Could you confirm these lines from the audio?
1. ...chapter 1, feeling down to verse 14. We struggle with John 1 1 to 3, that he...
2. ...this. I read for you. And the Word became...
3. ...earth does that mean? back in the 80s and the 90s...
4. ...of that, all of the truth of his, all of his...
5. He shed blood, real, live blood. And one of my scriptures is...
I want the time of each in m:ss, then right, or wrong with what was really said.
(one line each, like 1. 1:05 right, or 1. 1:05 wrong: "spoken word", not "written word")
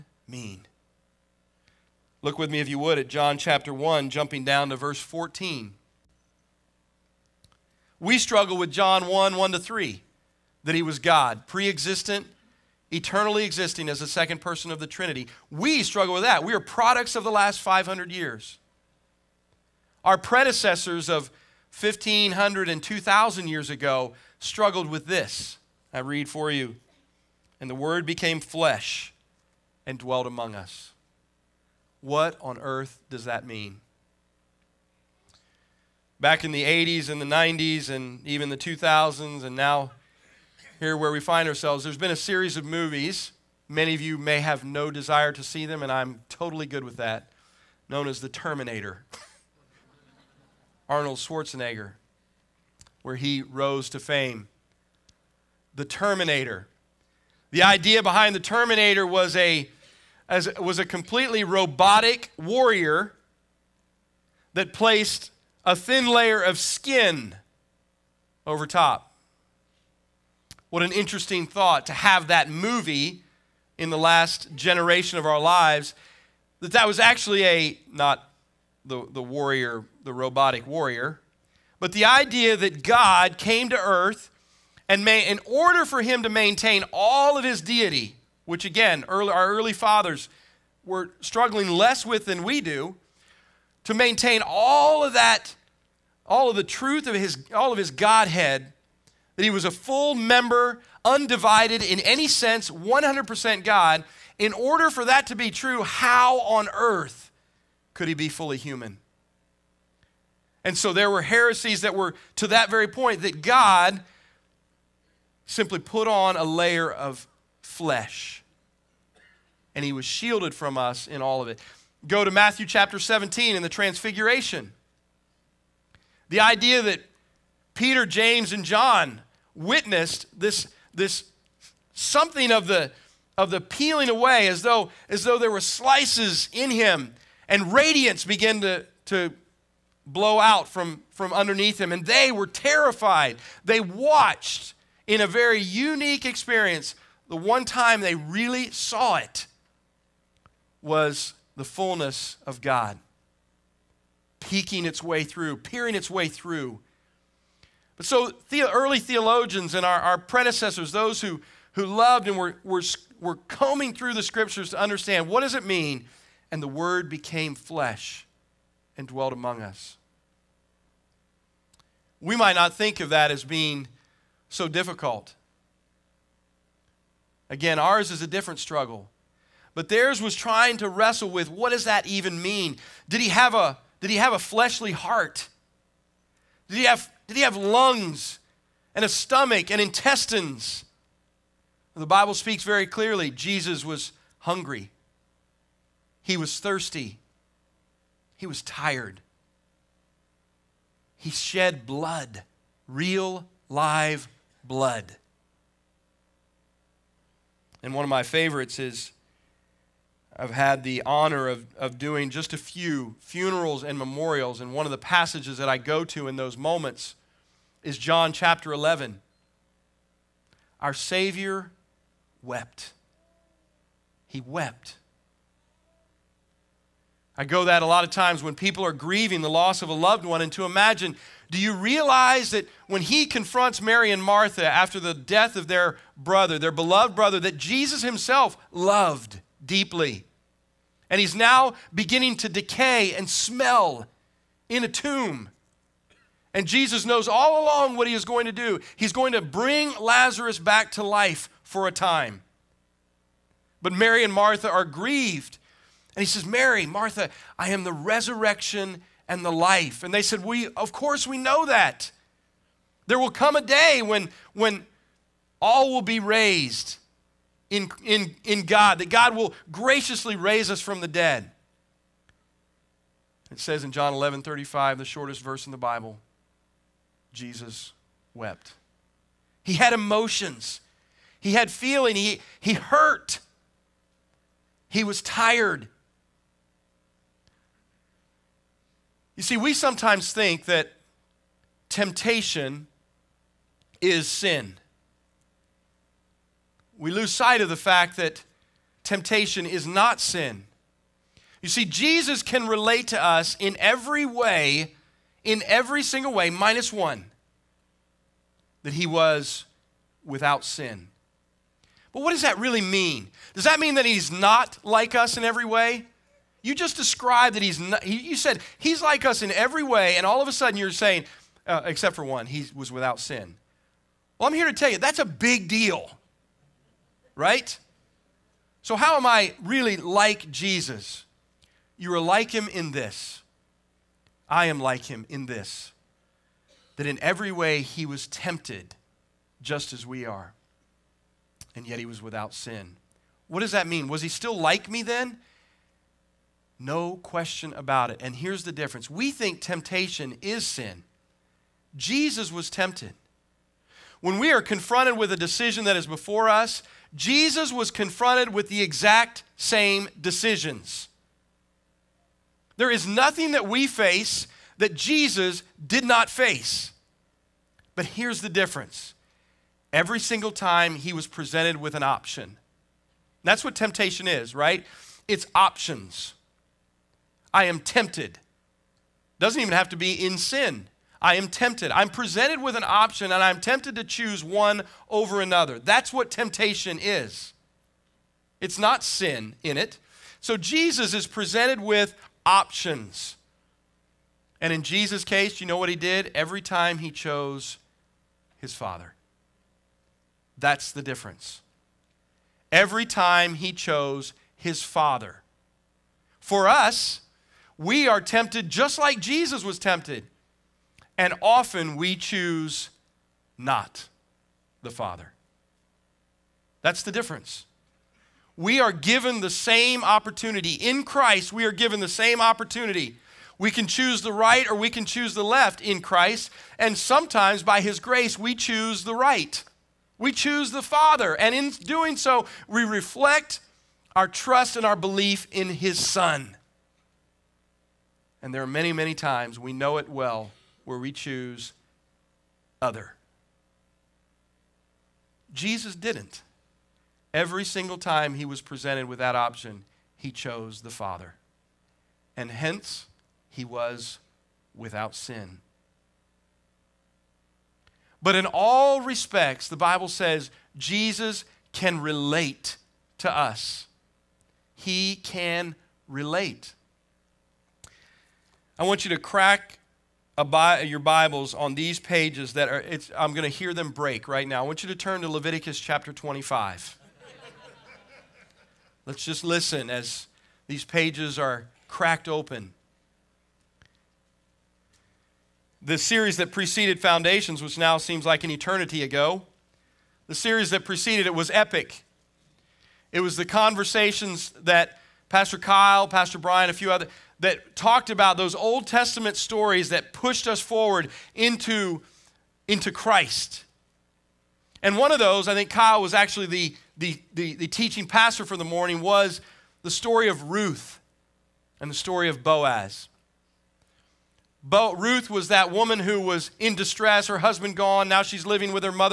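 1. 0:03 wrong: "jumping", not "feeling"
2. 0:25 right
3. 0:32 right
4. 1:35 right
5. 3:21 wrong: "favorites", not "scriptures".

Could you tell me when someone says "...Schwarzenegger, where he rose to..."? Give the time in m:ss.
0:51.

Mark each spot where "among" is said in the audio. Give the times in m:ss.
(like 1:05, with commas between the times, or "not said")
0:30, 2:49.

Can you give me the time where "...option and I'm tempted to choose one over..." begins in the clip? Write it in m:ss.
6:22.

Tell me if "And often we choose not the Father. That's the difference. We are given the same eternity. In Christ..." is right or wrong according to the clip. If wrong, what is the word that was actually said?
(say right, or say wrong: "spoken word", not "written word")
wrong: "opportunity", not "eternity".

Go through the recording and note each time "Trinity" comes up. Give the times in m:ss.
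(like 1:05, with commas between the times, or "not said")
0:14.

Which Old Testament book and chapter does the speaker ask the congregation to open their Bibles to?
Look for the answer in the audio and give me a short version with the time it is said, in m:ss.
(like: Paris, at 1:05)
Leviticus 25, at 7:55.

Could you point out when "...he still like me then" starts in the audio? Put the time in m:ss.
5:44.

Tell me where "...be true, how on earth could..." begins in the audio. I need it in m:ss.
1:45.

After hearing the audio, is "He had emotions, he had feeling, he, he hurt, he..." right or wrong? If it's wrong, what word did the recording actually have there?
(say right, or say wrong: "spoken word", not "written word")
right.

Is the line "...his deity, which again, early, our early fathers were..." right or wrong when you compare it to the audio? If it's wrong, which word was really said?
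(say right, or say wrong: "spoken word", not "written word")
right.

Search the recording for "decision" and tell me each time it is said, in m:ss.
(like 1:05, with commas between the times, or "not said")
5:55, 6:00.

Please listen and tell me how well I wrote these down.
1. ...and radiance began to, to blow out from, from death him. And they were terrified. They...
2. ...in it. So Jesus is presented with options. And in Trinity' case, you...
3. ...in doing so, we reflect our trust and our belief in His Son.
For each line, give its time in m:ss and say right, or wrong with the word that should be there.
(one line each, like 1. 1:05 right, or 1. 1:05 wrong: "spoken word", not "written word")
1. 2:17 wrong: "underneath", not "death"
2. 6:29 wrong: "Jesus", not "Trinity"
3. 7:11 right.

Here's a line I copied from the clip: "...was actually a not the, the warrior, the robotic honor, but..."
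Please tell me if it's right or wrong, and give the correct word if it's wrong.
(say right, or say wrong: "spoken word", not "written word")
wrong: "warrior", not "honor".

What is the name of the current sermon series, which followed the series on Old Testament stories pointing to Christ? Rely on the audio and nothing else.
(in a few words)
Foundations.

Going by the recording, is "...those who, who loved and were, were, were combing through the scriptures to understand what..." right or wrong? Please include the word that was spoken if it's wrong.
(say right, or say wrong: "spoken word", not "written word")
right.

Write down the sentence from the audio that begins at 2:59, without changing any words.
But theirs was trying to wrestle with what does that even mean?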